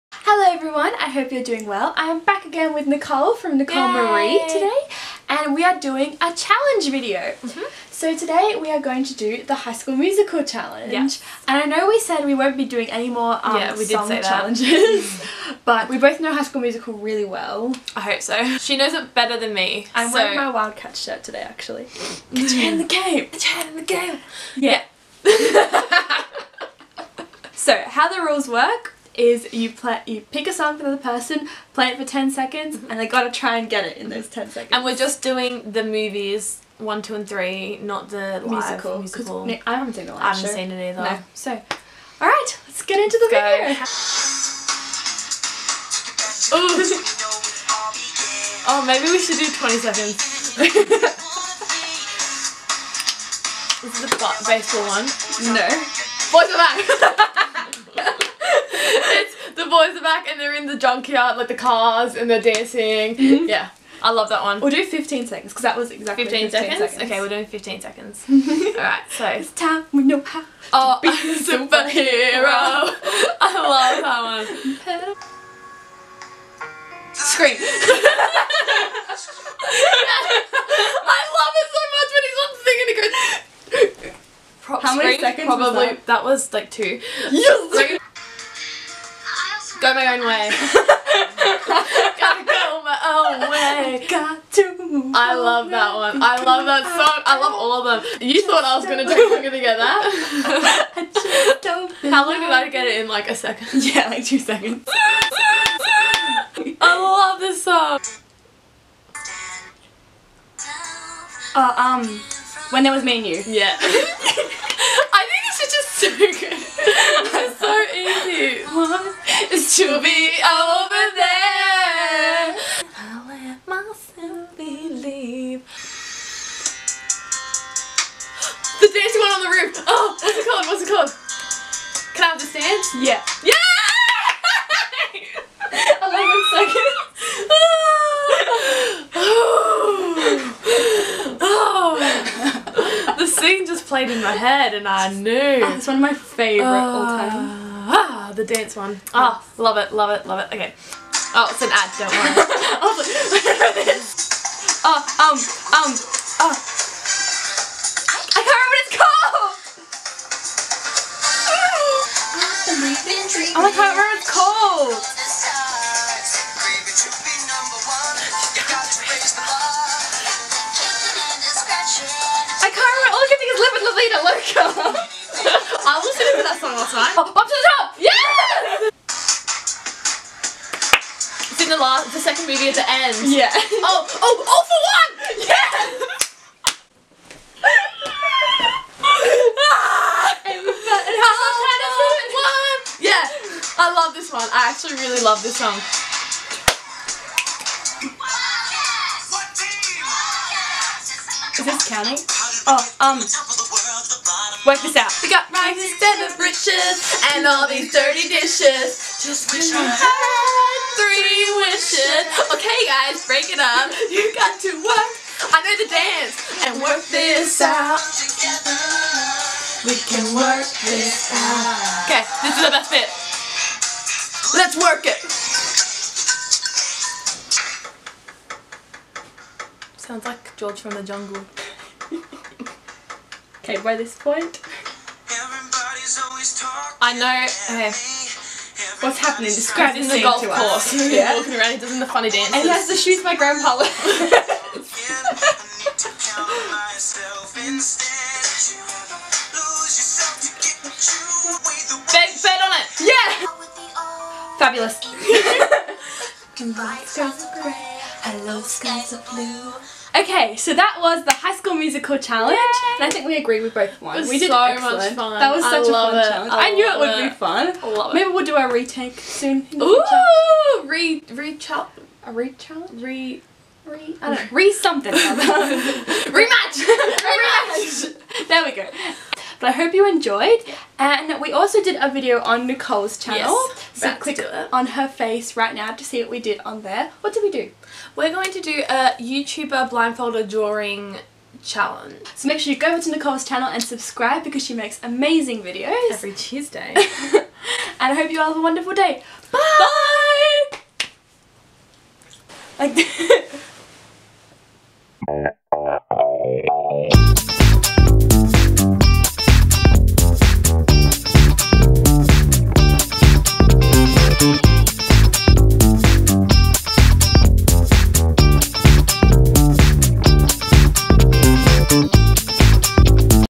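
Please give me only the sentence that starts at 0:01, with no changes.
I am back again with Nicole from Nicole Yay.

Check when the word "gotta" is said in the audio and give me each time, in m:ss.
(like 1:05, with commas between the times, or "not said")
0:33, 1:32.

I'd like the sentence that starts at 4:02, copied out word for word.
And he has the shoes my grandpa wears.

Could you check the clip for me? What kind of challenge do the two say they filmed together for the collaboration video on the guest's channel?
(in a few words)
YouTuber blindfolded drawing challenge.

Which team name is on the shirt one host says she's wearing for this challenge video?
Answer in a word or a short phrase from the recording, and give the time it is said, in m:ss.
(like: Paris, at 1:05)
Wildcat, at 0:20.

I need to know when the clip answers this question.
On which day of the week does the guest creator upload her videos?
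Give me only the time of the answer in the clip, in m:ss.
4:56.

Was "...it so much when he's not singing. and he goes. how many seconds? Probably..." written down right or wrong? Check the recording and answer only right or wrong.
right.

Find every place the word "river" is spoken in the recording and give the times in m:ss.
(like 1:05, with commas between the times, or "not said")
not said.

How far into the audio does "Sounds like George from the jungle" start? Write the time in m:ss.
3:49.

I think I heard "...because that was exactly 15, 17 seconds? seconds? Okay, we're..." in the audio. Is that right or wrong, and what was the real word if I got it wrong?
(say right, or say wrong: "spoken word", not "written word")
wrong: "15", not "17".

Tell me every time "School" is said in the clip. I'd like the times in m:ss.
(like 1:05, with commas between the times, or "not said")
0:09, 0:16, 4:21.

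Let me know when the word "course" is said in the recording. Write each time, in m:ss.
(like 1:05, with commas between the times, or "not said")
4:00.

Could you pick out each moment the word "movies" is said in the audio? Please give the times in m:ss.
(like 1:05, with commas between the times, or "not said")
0:35, 3:02.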